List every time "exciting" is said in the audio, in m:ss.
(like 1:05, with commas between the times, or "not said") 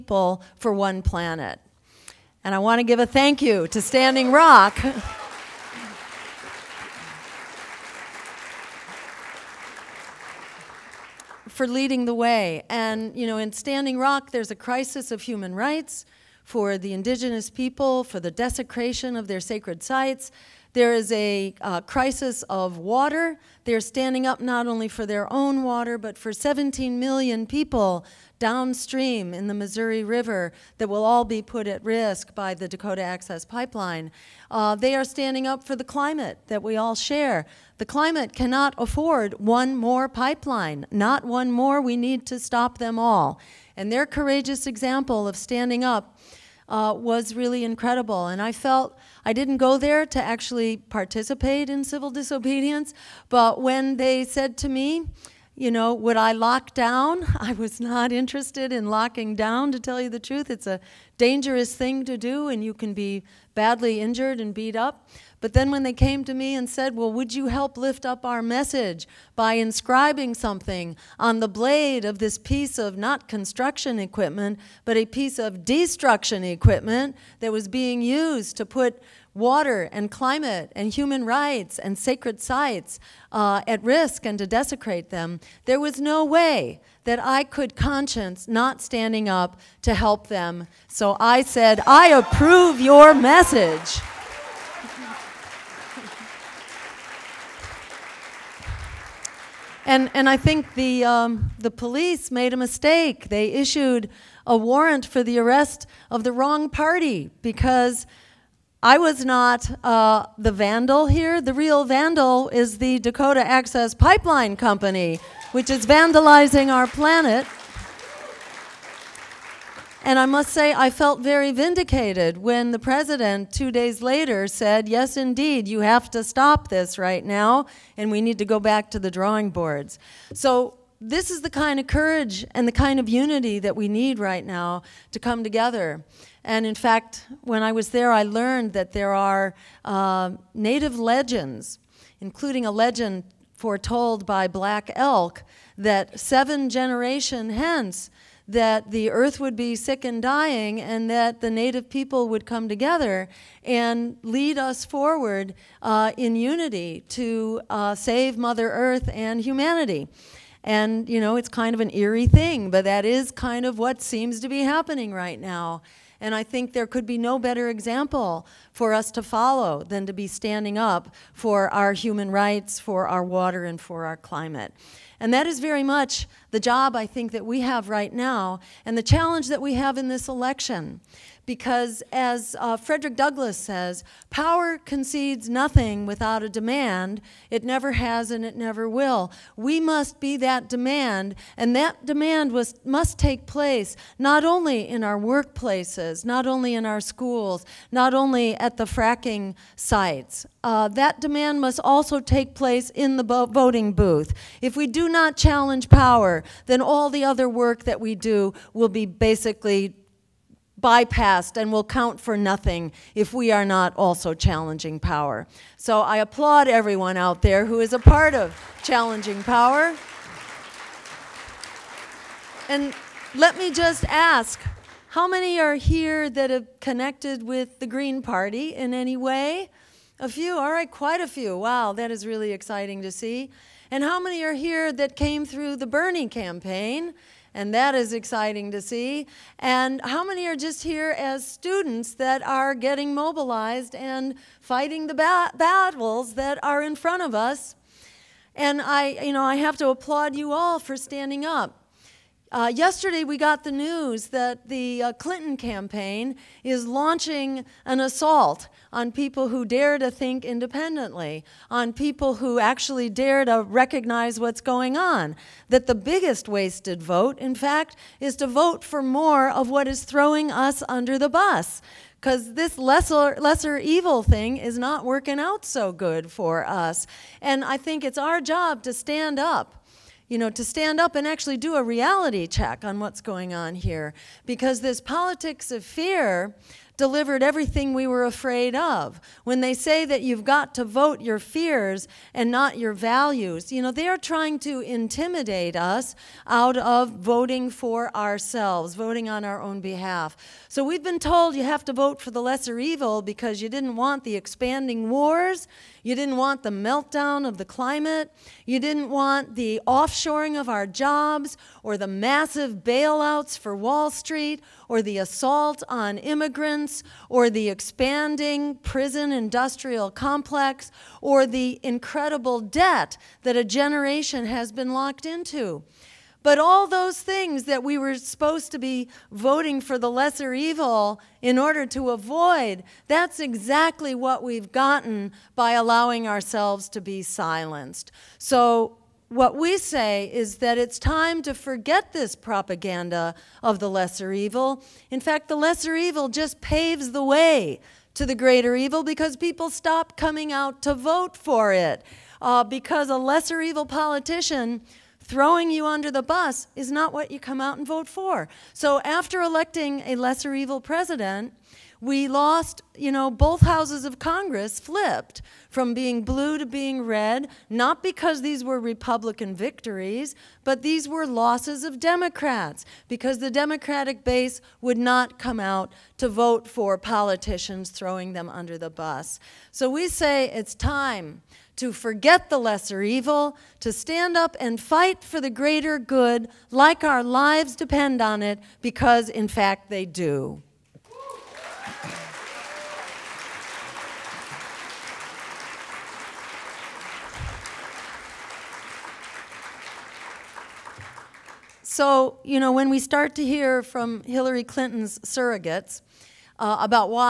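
3:52, 3:58.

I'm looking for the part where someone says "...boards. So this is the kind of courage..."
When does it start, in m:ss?
2:09.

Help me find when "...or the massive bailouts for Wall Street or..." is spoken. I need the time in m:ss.
5:11.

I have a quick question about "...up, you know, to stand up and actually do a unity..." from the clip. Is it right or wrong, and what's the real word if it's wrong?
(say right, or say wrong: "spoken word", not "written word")
wrong: "reality", not "unity".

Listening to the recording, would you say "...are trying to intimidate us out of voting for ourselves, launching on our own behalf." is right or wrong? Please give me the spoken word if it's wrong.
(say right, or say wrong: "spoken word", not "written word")
wrong: "voting", not "launching".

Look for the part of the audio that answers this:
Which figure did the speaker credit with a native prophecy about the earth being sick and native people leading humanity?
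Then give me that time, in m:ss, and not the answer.
2:24.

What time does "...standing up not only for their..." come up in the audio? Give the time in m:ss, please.
0:23.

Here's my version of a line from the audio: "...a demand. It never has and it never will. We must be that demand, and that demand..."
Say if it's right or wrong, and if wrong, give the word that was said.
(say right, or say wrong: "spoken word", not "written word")
right.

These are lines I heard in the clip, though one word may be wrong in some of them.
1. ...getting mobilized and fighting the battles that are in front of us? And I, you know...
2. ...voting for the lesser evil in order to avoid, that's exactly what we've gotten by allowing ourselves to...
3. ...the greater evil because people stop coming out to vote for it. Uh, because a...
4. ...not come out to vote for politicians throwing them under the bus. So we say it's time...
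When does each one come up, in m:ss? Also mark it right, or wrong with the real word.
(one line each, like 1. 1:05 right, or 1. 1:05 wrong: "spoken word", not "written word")
1. 4:02 right
2. 5:29 right
3. 5:48 right
4. 6:14 right.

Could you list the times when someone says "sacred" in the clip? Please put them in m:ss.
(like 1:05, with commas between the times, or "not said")
0:19, 1:21.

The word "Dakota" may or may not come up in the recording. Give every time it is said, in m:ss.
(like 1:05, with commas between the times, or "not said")
0:32, 1:52.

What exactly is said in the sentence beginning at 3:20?
Uh, that demand must also take place in the voting booth.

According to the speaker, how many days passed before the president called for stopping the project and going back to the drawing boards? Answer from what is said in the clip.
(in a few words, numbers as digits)
2.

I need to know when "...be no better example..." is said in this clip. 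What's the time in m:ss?
2:47.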